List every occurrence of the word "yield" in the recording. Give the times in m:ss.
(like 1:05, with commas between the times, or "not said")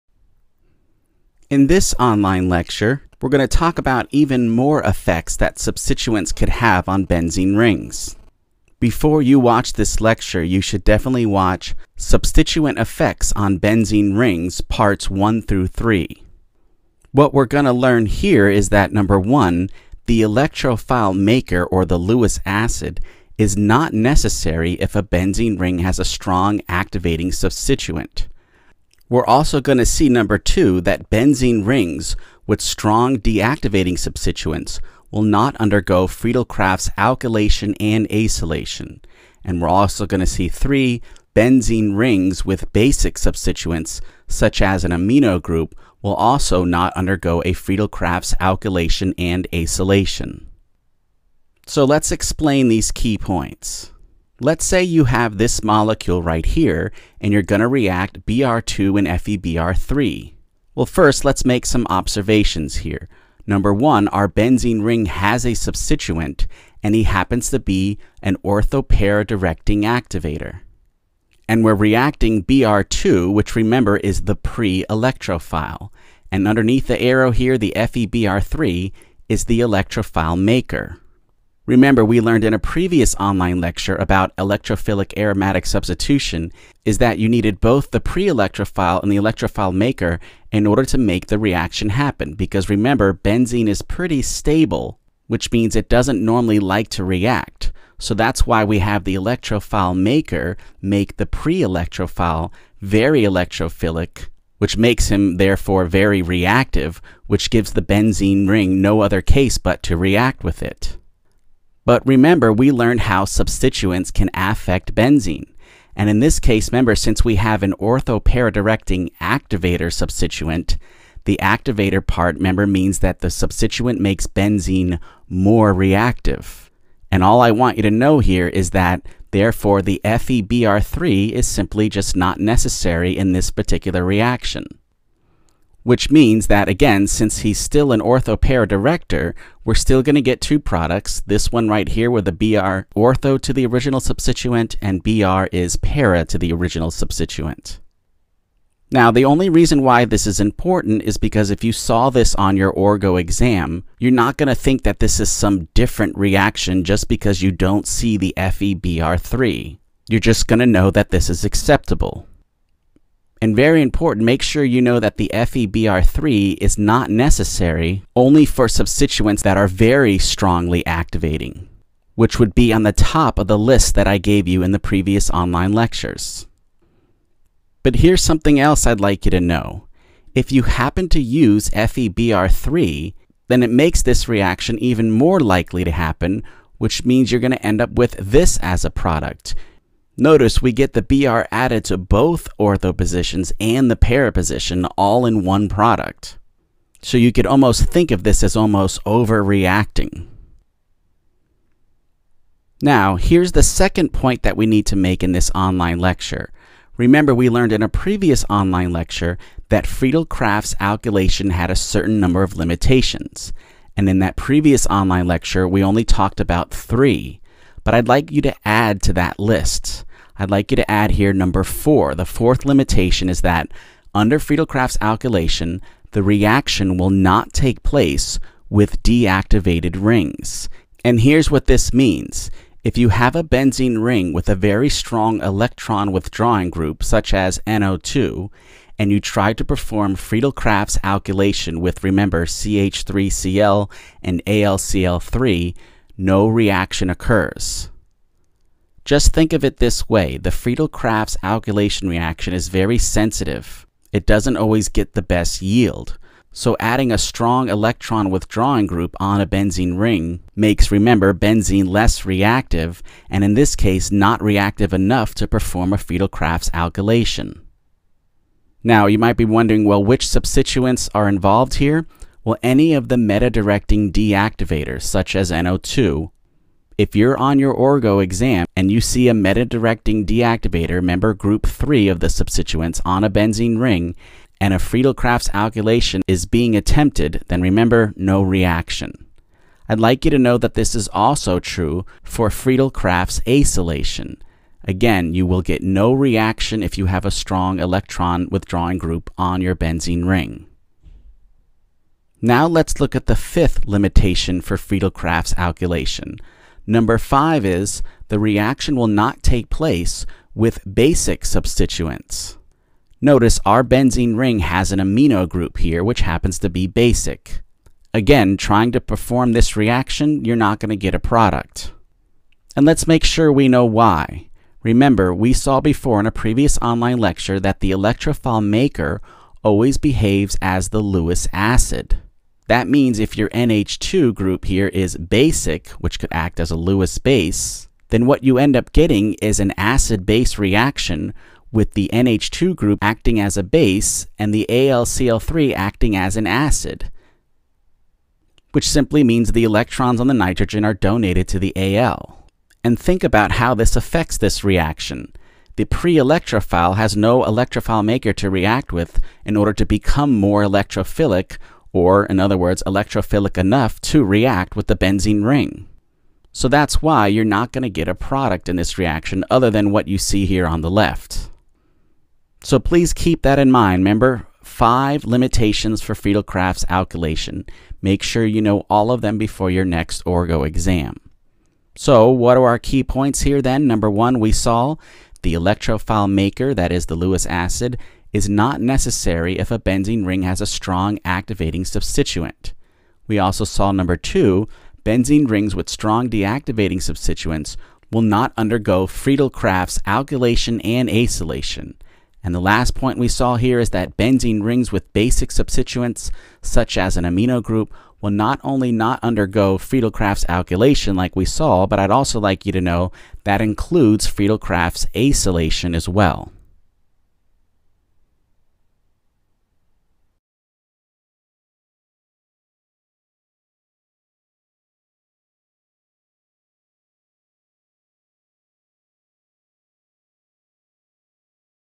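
4:15.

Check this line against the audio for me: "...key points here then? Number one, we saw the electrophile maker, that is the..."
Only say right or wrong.
right.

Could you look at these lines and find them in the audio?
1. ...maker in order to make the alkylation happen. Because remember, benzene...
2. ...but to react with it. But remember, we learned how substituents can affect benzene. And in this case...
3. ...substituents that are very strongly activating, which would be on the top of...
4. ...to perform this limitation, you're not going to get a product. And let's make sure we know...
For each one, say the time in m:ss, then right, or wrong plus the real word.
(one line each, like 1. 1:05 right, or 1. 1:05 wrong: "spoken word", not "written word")
1. 1:29 wrong: "reaction", not "alkylation"
2. 1:49 right
3. 2:48 right
4. 5:18 wrong: "reaction", not "limitation".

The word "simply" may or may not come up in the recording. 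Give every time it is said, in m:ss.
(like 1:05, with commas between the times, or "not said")
2:11, 5:48.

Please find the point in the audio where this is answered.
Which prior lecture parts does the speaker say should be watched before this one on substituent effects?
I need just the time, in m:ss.
0:14.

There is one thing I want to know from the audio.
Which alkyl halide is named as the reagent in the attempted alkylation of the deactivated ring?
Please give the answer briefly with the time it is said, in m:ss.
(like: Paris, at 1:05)
CH3Cl, at 4:02.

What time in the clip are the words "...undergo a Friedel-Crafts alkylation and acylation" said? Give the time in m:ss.
0:46.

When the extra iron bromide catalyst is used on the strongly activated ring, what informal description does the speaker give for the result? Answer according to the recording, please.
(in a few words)
overreacting.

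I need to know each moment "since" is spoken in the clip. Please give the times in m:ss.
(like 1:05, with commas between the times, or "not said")
1:56, 2:17.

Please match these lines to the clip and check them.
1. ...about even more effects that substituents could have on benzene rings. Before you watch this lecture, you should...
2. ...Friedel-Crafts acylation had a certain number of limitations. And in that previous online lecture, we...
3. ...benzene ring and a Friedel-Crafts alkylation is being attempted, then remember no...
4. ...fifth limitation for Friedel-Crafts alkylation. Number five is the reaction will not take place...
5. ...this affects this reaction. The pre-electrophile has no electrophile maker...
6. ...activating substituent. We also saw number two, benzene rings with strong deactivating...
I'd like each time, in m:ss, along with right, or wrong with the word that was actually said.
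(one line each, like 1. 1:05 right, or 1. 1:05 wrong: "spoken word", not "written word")
1. 0:03 right
2. 3:29 wrong: "alkylation", not "acylation"
3. 4:43 right
4. 5:03 right
5. 5:53 right
6. 6:31 right.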